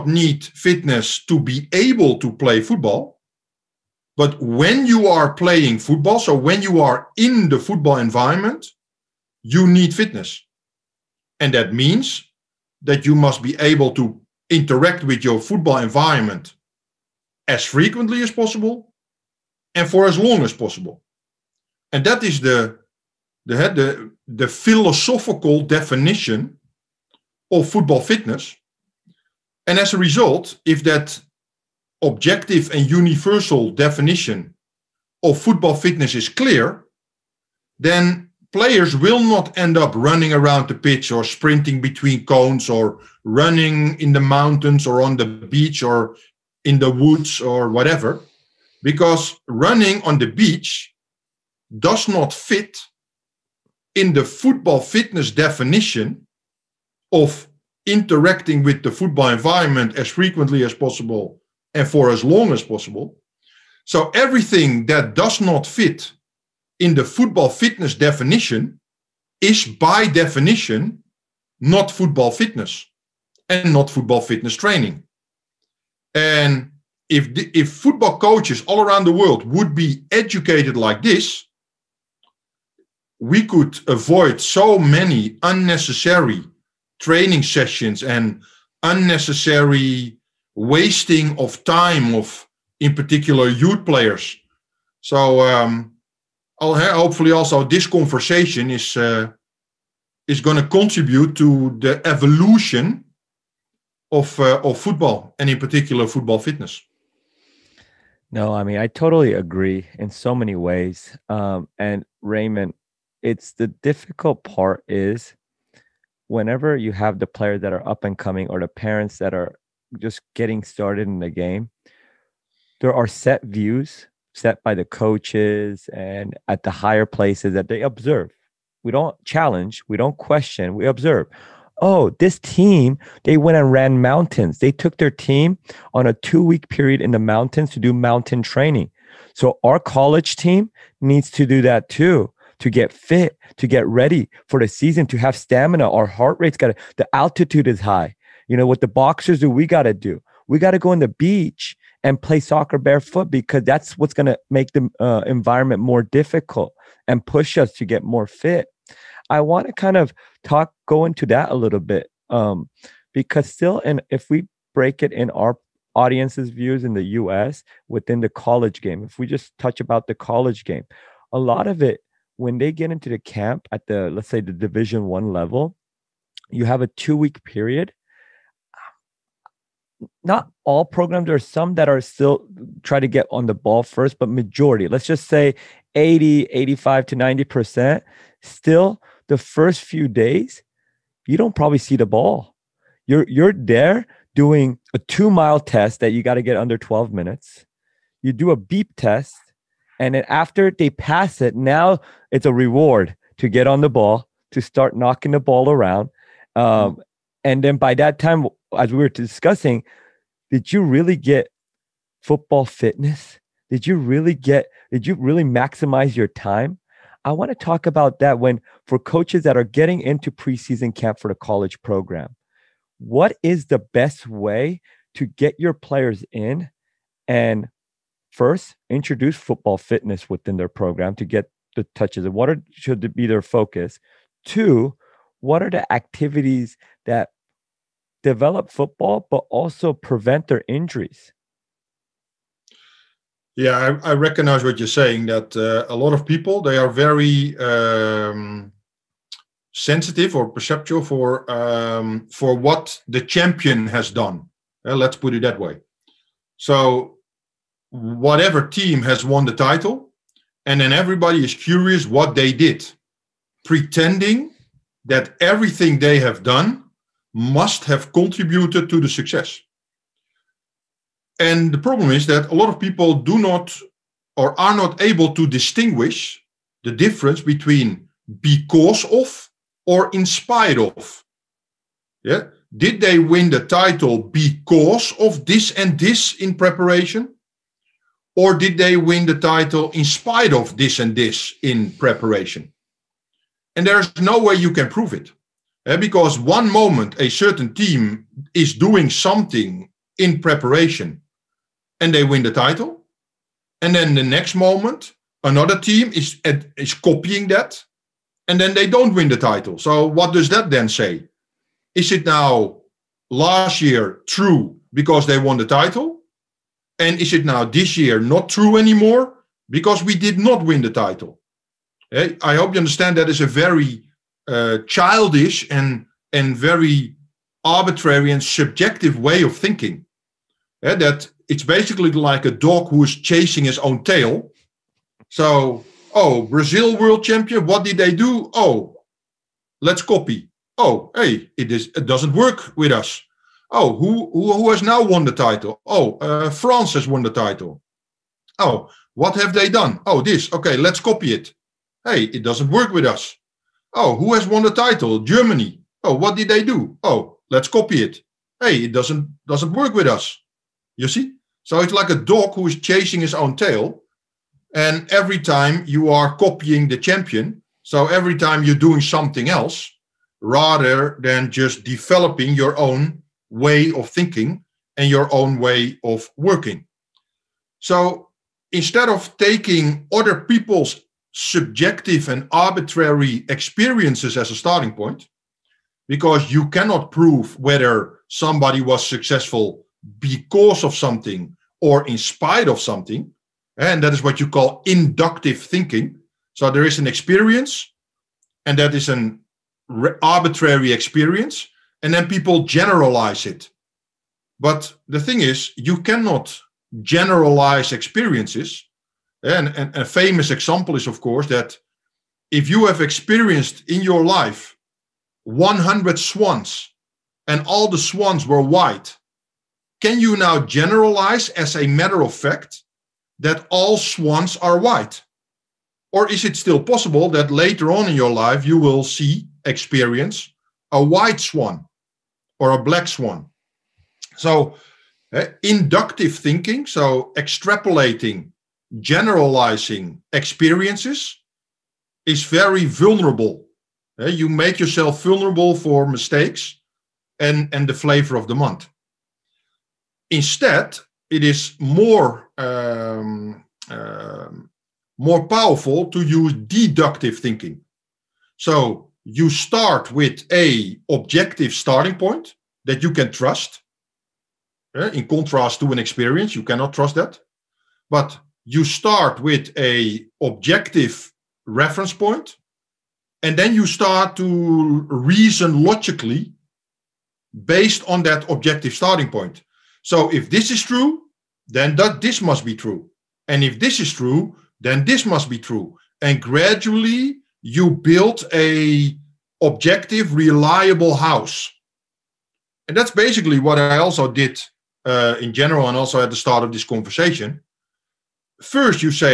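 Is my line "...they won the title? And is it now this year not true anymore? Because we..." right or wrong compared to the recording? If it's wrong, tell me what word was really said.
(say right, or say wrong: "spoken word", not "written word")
right.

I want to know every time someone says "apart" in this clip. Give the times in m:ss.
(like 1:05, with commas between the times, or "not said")
not said.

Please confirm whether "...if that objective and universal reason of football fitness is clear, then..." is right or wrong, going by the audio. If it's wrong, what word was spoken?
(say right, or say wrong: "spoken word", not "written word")
wrong: "definition", not "reason".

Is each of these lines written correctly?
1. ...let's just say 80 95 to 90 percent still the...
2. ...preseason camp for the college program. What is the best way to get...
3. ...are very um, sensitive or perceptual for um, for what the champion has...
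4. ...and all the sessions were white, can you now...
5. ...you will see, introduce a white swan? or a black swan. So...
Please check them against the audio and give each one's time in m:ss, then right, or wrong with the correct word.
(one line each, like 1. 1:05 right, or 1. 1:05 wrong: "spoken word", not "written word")
1. 3:04 wrong: "85", not "95"
2. 3:40 right
3. 4:06 right
4. 6:57 wrong: "swans", not "sessions"
5. 7:08 wrong: "experience", not "introduce".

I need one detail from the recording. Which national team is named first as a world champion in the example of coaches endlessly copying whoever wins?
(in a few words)
Brazil.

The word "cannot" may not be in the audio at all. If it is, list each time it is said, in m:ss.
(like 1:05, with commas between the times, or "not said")
6:26, 6:46, 7:46.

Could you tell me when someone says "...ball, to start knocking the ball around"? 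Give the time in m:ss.
3:23.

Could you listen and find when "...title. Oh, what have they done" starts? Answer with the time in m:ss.
5:47.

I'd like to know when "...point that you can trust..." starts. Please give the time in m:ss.
7:42.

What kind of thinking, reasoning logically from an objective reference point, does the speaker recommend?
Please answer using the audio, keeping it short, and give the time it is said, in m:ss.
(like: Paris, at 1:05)
Deductive thinking, at 7:36.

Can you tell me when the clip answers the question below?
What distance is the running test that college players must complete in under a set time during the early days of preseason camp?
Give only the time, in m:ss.
3:14.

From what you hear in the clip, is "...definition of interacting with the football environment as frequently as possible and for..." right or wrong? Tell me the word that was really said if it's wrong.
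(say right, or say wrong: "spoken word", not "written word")
right.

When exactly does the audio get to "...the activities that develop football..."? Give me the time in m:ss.
3:55.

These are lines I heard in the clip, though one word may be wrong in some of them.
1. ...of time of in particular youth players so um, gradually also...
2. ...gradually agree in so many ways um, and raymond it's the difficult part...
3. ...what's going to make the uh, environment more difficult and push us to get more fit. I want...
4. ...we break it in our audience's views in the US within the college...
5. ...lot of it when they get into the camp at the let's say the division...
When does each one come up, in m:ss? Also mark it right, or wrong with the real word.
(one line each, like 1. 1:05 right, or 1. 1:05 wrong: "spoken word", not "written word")
1. 1:31 wrong: "hopefully", not "gradually"
2. 1:48 wrong: "totally", not "gradually"
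3. 2:33 right
4. 2:44 right
5. 2:51 right.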